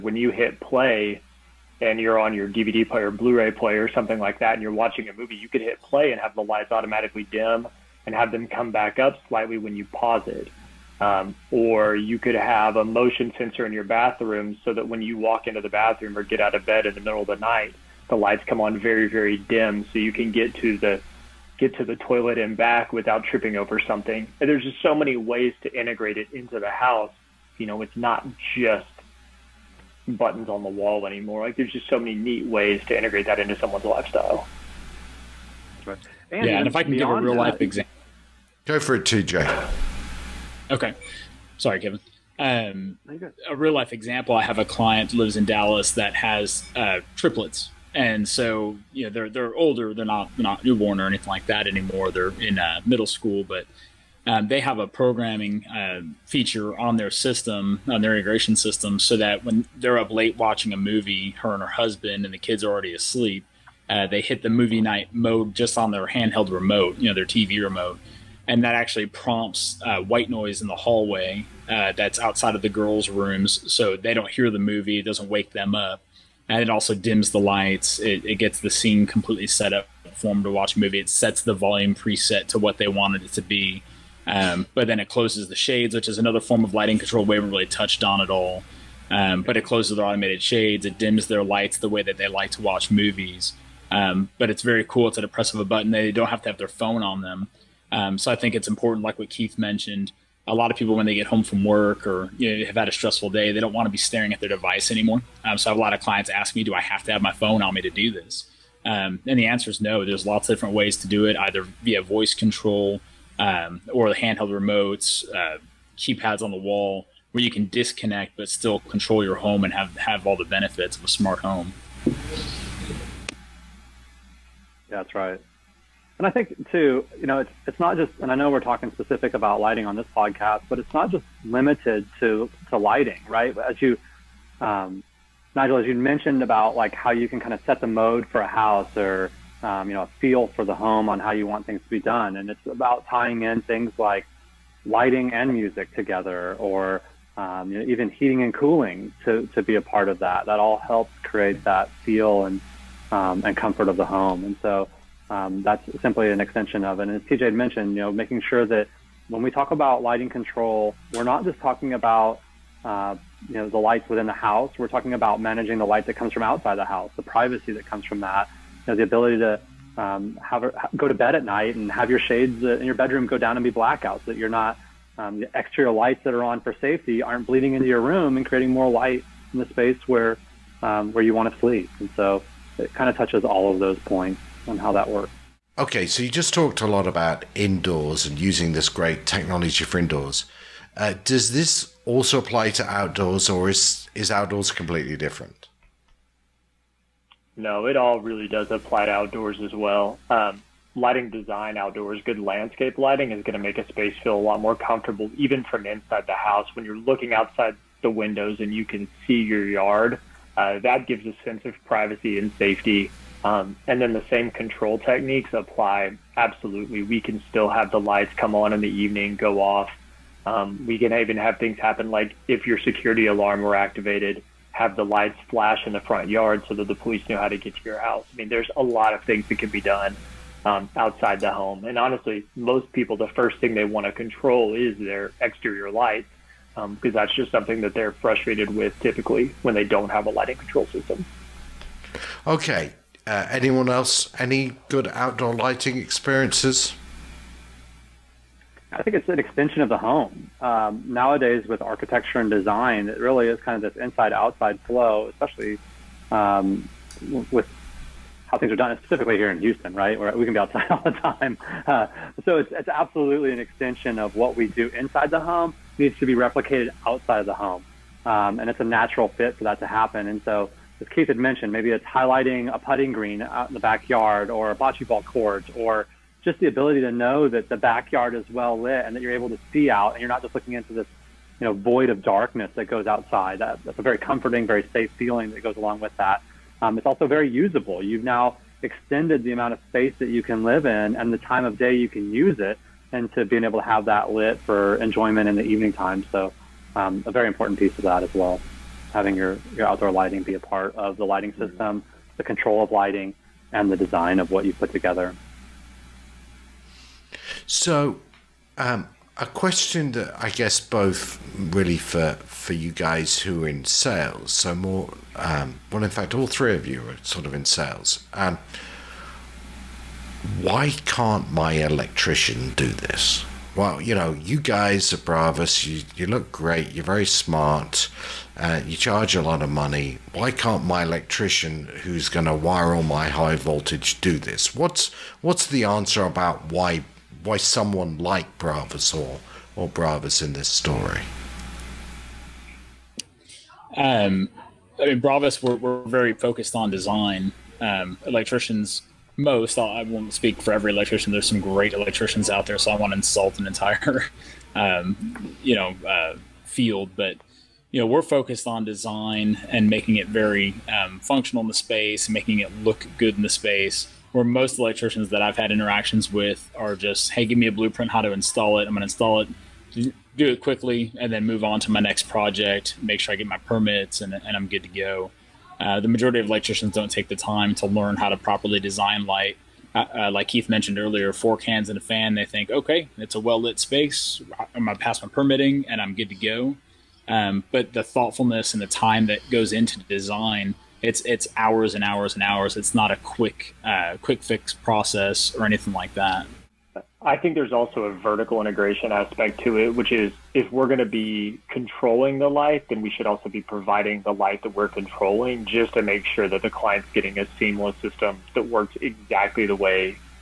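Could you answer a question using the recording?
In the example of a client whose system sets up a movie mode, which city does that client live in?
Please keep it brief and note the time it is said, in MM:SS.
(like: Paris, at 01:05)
Dallas, at 00:45.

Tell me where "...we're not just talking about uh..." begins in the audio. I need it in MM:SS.
02:41.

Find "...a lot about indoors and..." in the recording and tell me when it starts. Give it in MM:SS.
03:06.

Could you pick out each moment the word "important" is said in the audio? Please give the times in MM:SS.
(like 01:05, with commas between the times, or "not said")
01:38, 04:57.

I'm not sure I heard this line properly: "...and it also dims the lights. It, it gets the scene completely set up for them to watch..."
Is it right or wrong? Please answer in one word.
right.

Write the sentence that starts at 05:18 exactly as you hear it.
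Um, why can't my electrician do this?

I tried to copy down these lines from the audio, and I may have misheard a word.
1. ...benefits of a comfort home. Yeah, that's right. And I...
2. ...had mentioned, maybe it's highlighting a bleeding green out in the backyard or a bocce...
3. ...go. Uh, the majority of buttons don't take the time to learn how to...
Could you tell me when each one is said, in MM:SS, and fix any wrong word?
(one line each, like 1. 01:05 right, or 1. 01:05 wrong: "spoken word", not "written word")
1. 02:00 wrong: "smart", not "comfort"
2. 04:31 wrong: "putting", not "bleeding"
3. 06:14 wrong: "electricians", not "buttons".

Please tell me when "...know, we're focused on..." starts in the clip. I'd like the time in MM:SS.
05:57.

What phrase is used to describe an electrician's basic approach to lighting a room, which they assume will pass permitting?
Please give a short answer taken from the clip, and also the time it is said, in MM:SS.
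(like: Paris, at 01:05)
Four cans and a fan, at 06:21.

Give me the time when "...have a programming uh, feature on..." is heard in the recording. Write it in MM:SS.
00:54.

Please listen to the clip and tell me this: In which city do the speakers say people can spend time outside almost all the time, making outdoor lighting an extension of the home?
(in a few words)
Houston.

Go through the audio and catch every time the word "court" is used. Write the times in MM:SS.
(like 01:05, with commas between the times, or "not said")
04:35.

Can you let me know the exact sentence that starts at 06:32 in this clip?
It's not a quick uh, quick fix process or anything like that.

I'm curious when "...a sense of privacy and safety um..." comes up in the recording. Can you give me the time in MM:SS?
03:31.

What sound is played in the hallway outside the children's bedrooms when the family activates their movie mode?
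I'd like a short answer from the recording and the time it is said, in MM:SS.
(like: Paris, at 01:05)
White noise, at 01:09.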